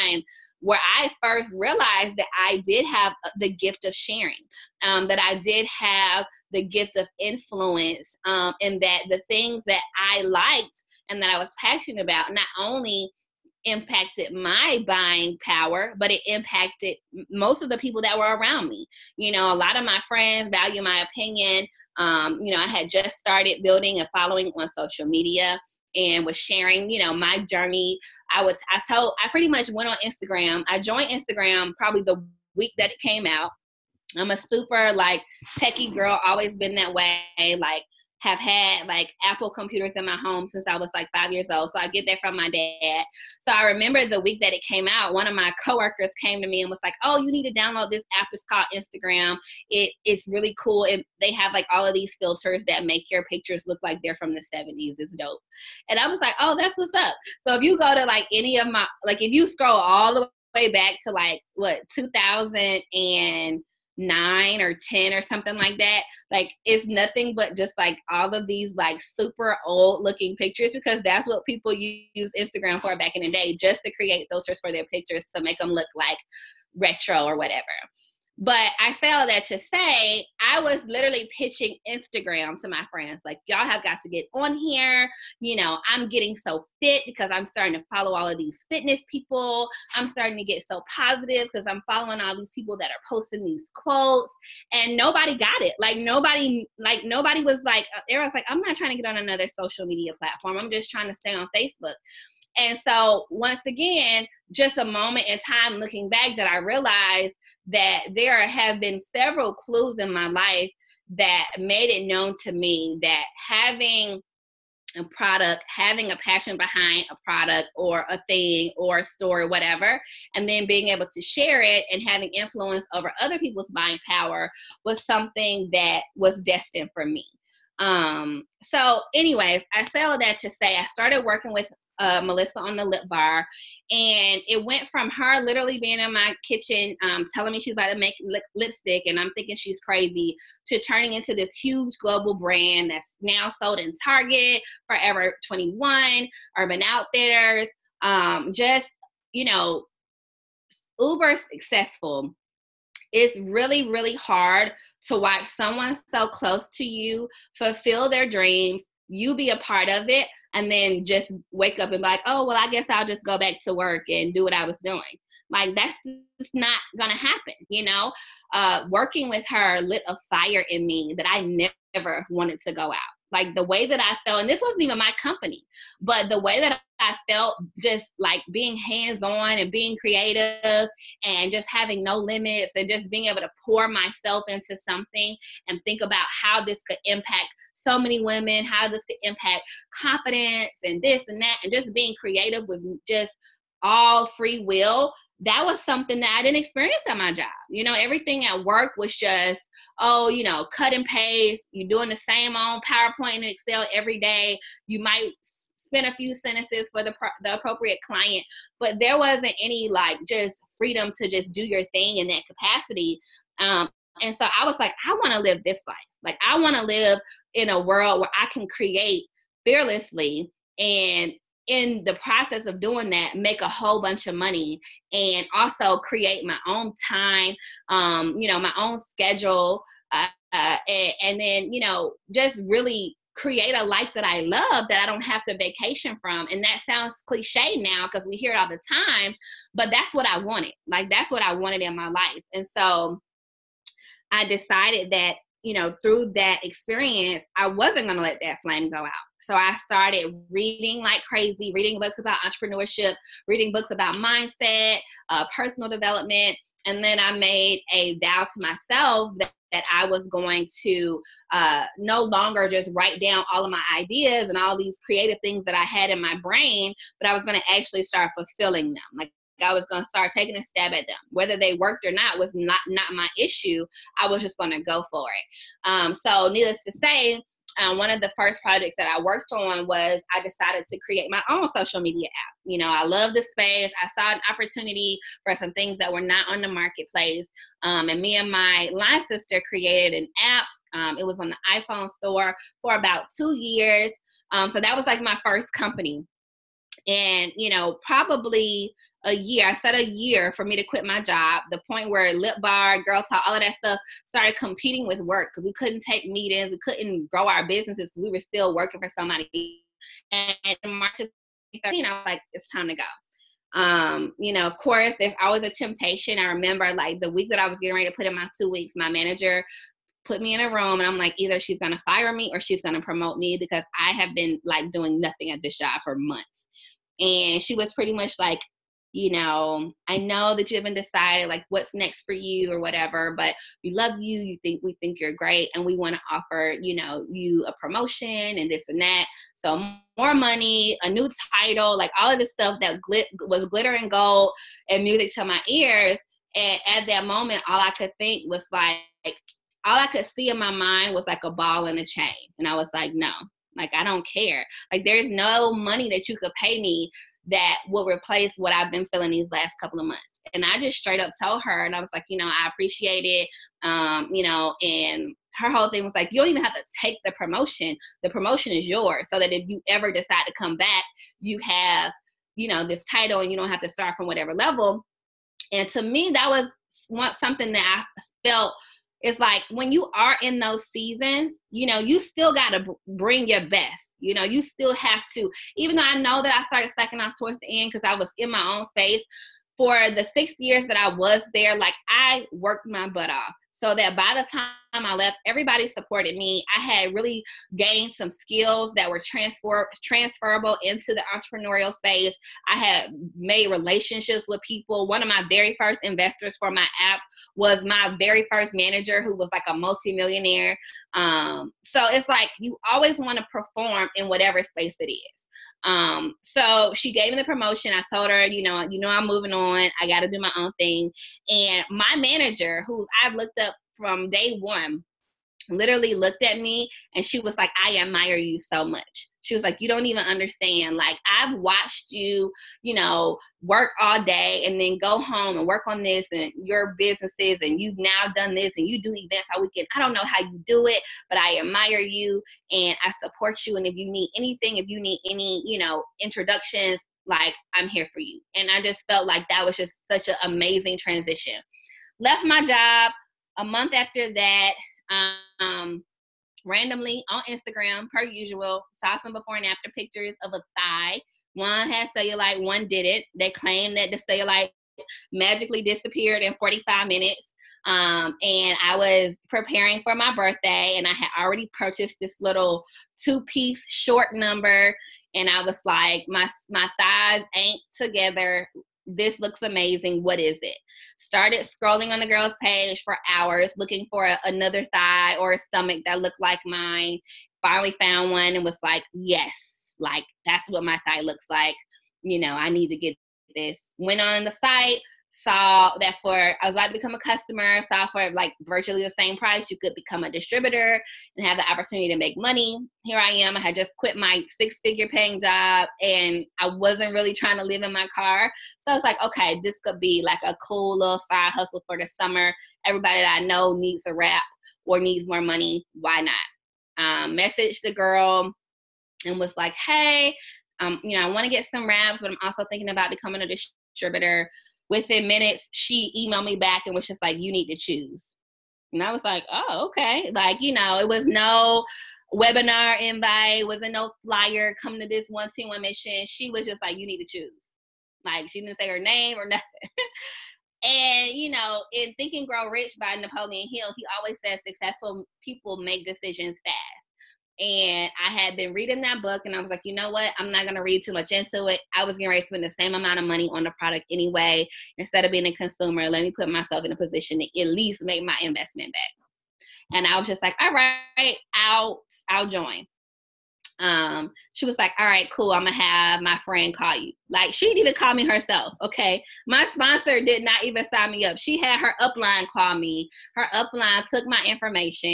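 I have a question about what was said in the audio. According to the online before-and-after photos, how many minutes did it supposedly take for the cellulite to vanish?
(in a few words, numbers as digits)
45.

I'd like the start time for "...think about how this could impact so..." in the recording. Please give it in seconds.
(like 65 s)
185 s.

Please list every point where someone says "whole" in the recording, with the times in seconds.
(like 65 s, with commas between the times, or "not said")
223 s, 365 s.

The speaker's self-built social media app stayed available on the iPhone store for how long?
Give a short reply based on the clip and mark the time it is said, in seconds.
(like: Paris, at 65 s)
2 years, at 292 s.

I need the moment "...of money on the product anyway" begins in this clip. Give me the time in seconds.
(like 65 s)
553 s.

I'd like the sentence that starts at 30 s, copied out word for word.
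I joined Instagram probably the week that it came out.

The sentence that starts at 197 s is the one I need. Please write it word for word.
You know, everything at work was just, oh, you know, cut and paste.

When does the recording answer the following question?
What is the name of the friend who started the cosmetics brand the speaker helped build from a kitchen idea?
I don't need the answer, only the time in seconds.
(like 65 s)
132 s.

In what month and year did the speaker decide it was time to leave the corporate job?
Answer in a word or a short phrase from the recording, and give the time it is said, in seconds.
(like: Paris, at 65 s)
March 2013, at 310 s.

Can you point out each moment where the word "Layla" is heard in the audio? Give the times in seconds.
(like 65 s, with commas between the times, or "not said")
not said.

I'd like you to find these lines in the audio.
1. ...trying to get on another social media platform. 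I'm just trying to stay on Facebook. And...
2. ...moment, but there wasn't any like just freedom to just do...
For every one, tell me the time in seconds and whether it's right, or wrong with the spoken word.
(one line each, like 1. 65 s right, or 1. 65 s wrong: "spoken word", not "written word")
1. 98 s right
2. 208 s wrong: "client", not "moment".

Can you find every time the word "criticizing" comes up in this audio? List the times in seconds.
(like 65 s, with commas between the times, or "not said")
not said.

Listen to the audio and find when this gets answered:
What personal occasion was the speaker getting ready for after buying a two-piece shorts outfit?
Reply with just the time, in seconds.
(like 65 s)
470 s.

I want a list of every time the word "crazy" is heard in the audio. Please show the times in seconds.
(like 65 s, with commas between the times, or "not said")
139 s, 251 s.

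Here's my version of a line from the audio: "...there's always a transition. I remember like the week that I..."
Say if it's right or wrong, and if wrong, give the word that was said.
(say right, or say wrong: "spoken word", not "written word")
wrong: "temptation", not "transition".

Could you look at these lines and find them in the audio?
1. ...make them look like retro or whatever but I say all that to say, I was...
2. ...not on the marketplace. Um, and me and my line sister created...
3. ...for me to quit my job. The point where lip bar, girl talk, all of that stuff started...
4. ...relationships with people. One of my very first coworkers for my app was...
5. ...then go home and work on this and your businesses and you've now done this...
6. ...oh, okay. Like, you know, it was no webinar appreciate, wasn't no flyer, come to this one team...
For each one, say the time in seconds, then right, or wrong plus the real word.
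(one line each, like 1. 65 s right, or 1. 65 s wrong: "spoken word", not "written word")
1. 75 s right
2. 286 s right
3. 300 s right
4. 403 s wrong: "investors", not "coworkers"
5. 434 s right
6. 529 s wrong: "invite", not "appreciate".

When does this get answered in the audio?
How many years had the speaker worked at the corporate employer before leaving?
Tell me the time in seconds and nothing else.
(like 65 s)
390 s.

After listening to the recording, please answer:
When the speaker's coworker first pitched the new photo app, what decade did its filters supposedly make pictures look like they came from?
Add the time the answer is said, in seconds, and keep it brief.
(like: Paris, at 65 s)
the 70s, at 54 s.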